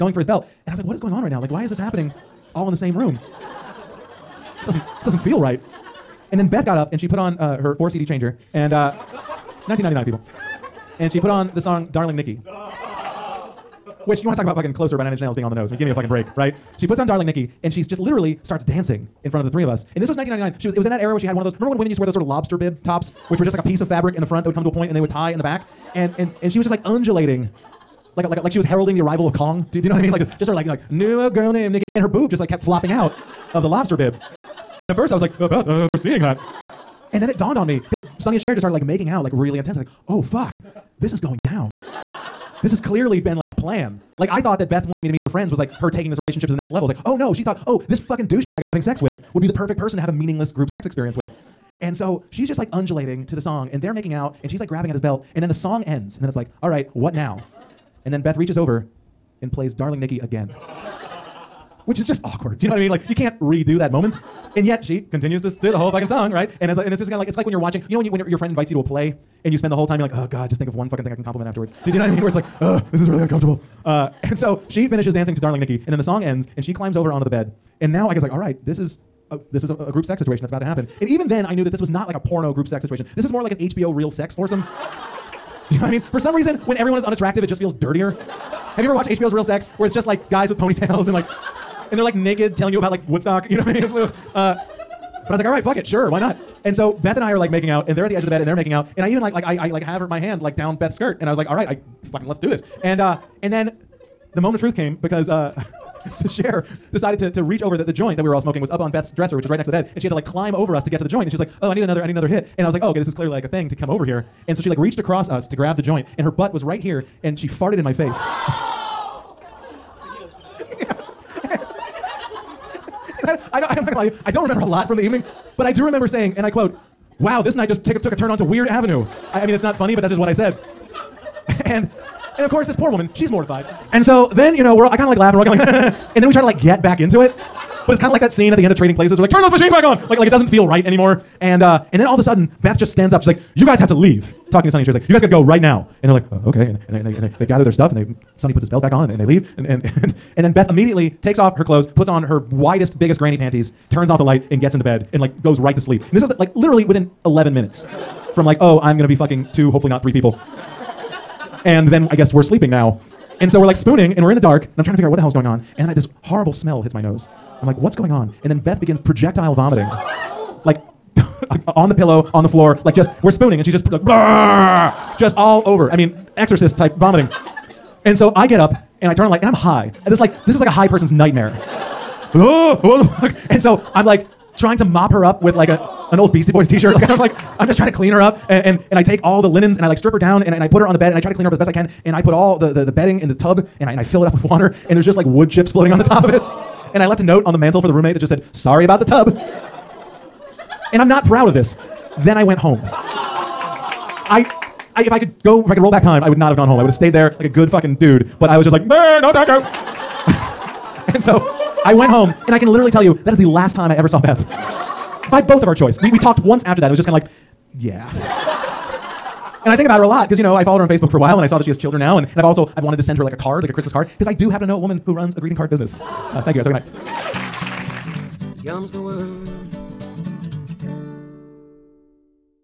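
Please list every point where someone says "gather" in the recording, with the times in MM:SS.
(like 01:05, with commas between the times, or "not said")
02:27.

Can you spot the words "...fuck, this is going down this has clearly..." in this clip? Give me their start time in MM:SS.
00:40.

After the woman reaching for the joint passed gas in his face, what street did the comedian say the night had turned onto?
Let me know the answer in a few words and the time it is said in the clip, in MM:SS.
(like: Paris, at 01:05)
Weird Avenue, at 02:08.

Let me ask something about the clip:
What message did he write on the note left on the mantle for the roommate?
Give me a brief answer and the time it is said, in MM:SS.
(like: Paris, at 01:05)
Sorry about the tub, at 03:18.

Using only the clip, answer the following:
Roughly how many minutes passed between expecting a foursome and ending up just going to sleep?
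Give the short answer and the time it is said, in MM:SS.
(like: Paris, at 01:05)
11, at 02:37.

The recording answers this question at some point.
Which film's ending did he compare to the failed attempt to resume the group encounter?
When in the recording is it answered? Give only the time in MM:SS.
02:18.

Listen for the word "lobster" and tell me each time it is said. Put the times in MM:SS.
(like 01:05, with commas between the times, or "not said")
00:22, 00:33.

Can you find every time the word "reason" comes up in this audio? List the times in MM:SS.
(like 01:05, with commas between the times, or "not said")
01:26.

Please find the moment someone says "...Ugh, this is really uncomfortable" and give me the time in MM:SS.
01:12.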